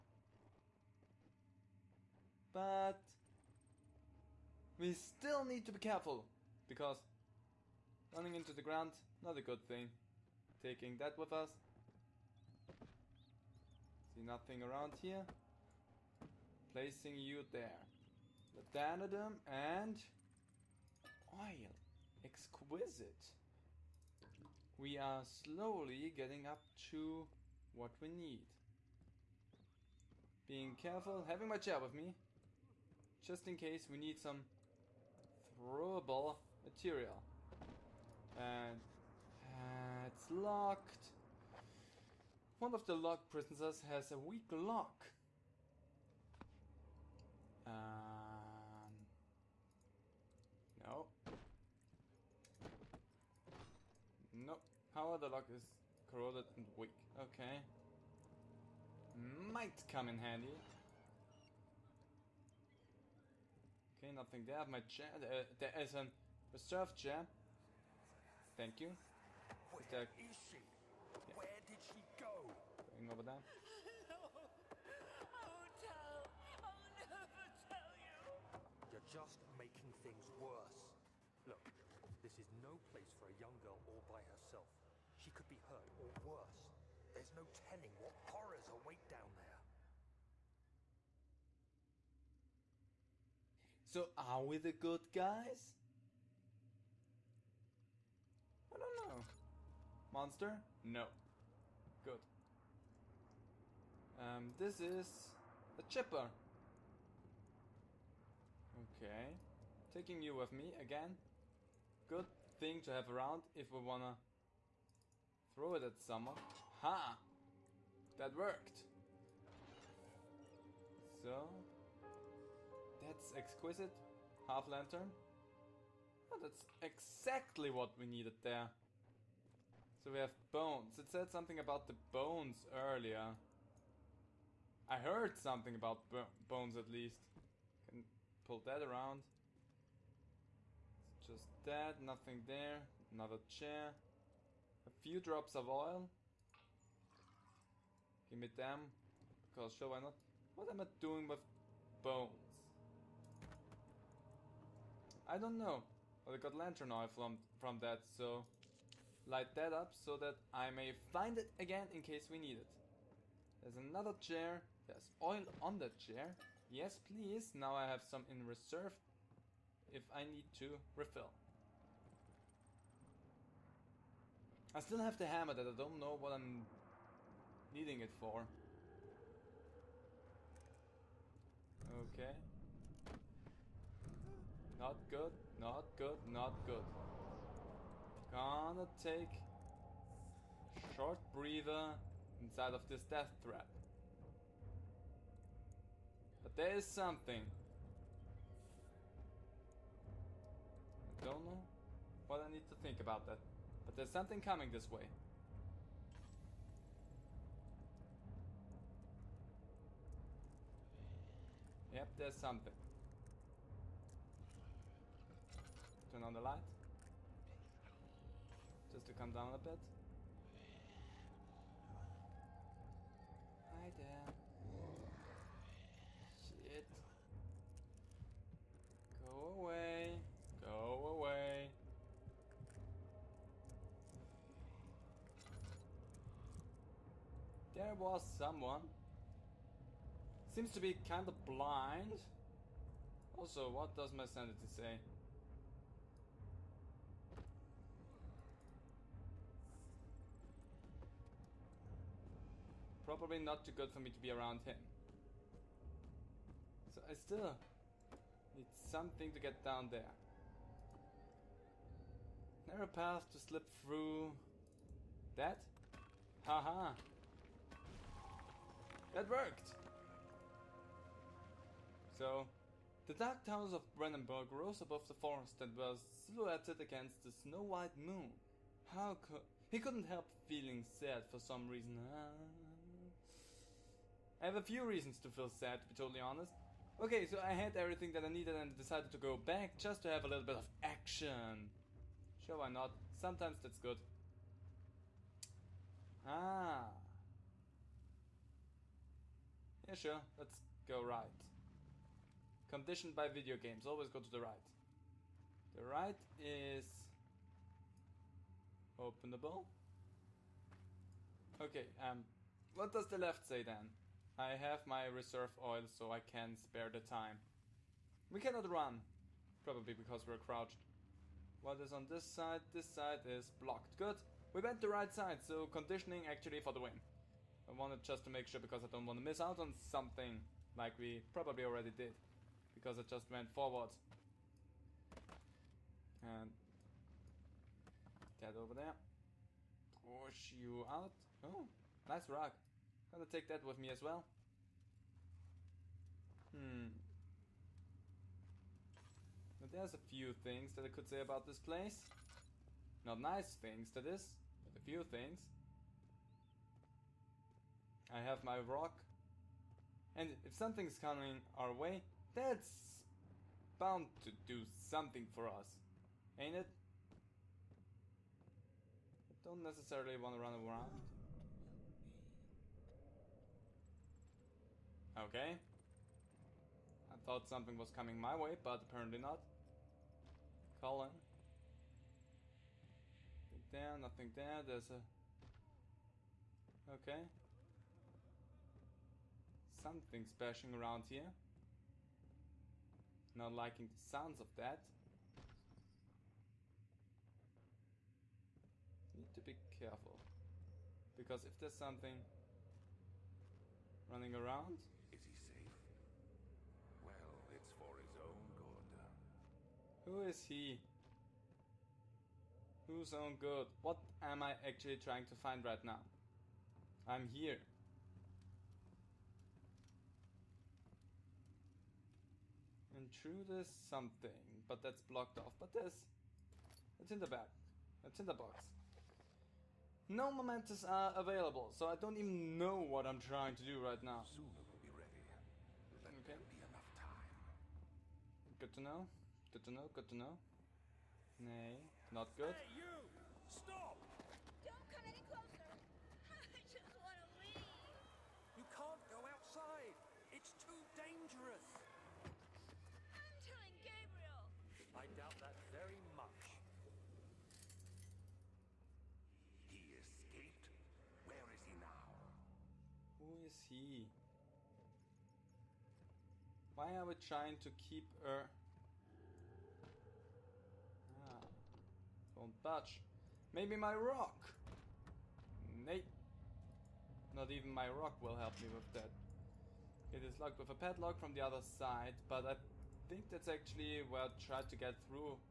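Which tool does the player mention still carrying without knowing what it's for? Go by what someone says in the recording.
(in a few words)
Hammer.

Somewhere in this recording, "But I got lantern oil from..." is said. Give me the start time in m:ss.
2:36.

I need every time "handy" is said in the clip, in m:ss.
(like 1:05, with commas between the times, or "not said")
1:00.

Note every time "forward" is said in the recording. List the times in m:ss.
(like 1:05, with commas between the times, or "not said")
5:33.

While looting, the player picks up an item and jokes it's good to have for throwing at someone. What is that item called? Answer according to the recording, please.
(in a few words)
Chipper.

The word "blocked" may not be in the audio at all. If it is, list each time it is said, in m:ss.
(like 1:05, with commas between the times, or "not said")
5:23, 7:05.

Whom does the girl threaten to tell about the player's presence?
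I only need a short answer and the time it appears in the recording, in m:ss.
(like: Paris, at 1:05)
Gabriel, at 7:33.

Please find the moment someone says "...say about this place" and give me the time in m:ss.
5:51.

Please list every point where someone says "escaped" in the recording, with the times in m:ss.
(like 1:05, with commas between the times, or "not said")
7:39.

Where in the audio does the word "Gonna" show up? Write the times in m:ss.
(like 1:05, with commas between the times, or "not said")
3:08, 5:43.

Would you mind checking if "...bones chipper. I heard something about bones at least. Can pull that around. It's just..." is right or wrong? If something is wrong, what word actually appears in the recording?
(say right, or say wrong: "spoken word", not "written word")
wrong: "earlier", not "chipper".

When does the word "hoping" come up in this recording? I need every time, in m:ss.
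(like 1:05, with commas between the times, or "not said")
not said.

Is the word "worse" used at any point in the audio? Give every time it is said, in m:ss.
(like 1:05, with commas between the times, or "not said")
1:20, 1:26.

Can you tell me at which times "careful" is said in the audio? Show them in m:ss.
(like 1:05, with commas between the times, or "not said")
0:05, 0:30, 6:39.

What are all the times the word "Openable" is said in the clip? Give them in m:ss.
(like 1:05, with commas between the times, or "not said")
5:08.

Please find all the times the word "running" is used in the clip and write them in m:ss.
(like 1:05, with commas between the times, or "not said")
0:08, 6:44.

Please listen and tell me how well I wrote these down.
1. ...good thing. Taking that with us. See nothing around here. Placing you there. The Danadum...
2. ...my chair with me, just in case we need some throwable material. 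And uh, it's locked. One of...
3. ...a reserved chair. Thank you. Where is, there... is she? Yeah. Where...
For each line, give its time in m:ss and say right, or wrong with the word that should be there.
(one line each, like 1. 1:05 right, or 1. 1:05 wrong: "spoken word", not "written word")
1. 0:09 right
2. 0:31 right
3. 1:05 right.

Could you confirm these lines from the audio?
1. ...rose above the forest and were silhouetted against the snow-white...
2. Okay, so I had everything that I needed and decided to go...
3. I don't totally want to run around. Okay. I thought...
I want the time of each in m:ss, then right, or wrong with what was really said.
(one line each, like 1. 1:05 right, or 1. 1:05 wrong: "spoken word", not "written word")
1. 4:34 right
2. 4:46 right
3. 6:09 wrong: "necessarily", not "totally".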